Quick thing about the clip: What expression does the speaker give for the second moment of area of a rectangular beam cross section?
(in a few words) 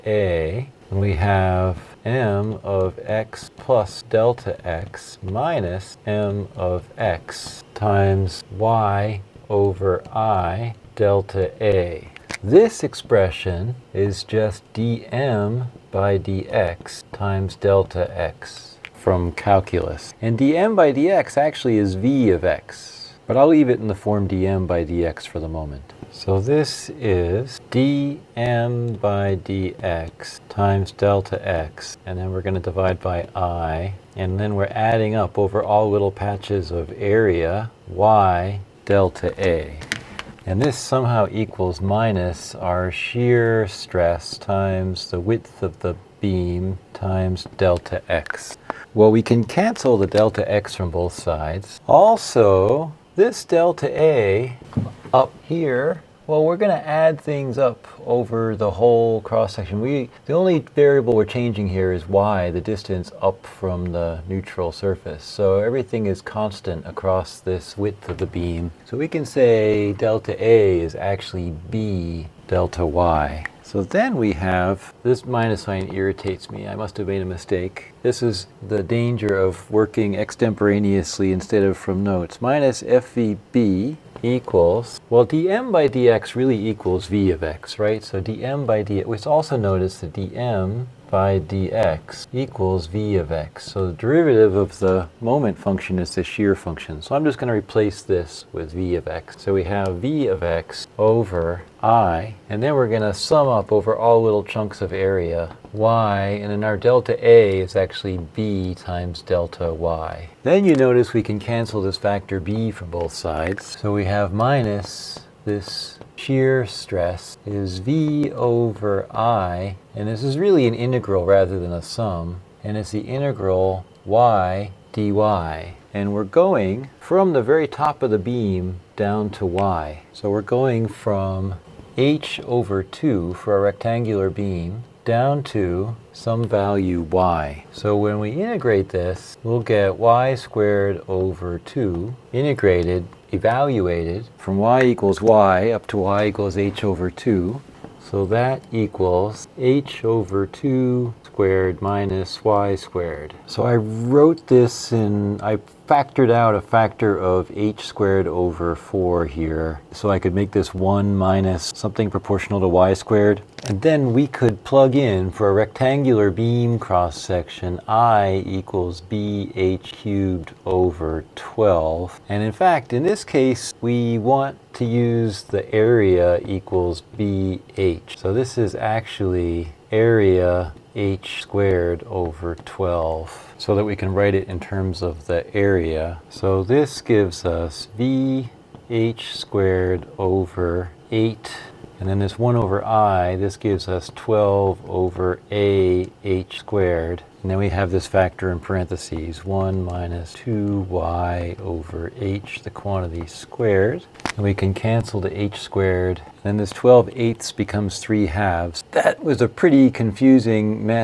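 BH cubed over 12.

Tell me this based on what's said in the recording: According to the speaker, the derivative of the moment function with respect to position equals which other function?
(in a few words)
Shear function.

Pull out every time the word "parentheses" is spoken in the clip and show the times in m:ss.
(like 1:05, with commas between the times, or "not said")
3:18.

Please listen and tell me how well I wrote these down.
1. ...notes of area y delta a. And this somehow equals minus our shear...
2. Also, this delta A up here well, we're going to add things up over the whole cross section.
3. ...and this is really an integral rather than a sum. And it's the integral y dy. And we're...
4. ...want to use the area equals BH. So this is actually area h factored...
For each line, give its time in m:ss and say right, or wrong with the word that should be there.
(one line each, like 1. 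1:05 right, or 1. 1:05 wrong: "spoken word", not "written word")
1. 0:36 wrong: "patches", not "notes"
2. 0:51 right
3. 1:59 right
4. 2:54 wrong: "squared", not "factored".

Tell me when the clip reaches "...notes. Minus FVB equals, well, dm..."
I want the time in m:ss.
1:22.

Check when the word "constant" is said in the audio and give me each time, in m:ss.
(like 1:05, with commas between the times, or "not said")
1:06.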